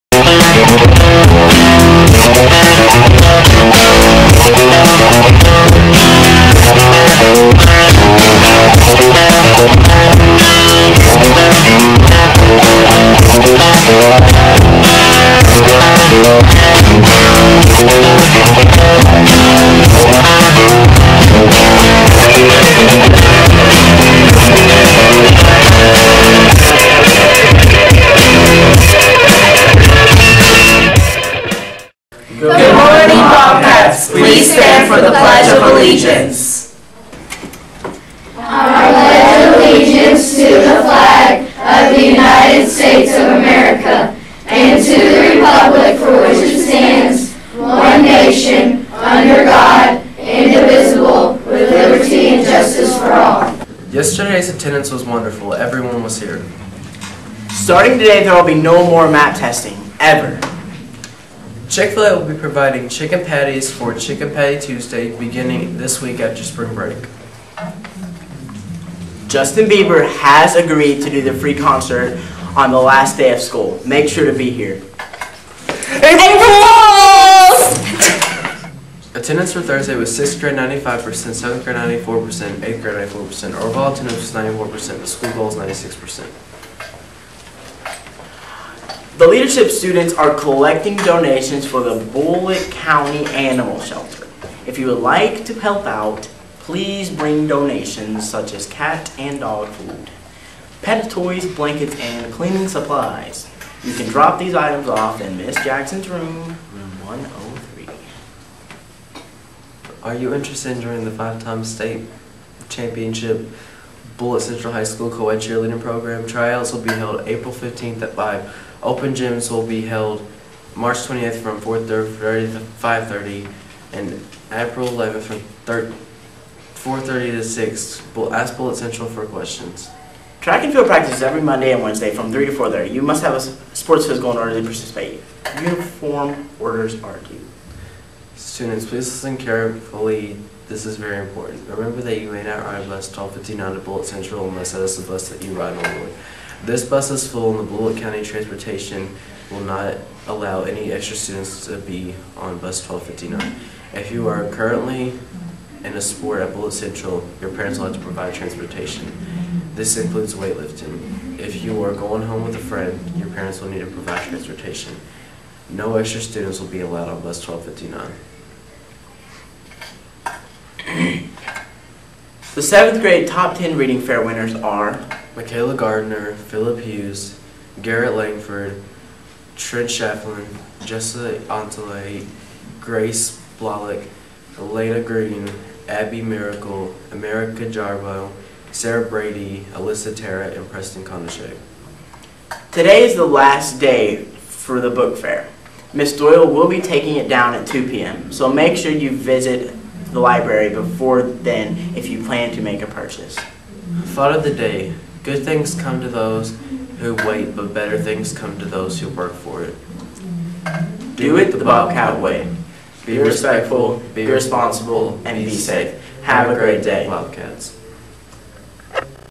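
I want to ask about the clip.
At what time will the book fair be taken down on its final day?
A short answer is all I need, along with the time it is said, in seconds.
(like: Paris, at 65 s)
2 p.m., at 197 s.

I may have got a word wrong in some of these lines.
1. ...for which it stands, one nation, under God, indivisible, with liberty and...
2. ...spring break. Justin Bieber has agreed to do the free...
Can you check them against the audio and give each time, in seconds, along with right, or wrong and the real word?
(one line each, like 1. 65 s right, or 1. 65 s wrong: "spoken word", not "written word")
1. 45 s right
2. 66 s right.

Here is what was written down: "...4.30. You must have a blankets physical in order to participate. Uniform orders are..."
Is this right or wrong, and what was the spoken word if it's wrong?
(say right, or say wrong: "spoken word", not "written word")
wrong: "sports", not "blankets".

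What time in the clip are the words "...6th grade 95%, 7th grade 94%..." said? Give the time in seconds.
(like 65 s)
80 s.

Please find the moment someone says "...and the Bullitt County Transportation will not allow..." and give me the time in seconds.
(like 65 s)
147 s.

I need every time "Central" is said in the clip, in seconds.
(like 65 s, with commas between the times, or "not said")
114 s, 128 s, 144 s, 156 s.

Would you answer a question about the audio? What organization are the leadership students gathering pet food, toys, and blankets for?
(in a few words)
Bullitt County Animal Shelter.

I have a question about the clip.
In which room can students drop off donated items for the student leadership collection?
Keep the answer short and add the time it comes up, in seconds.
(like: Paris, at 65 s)
103, at 106 s.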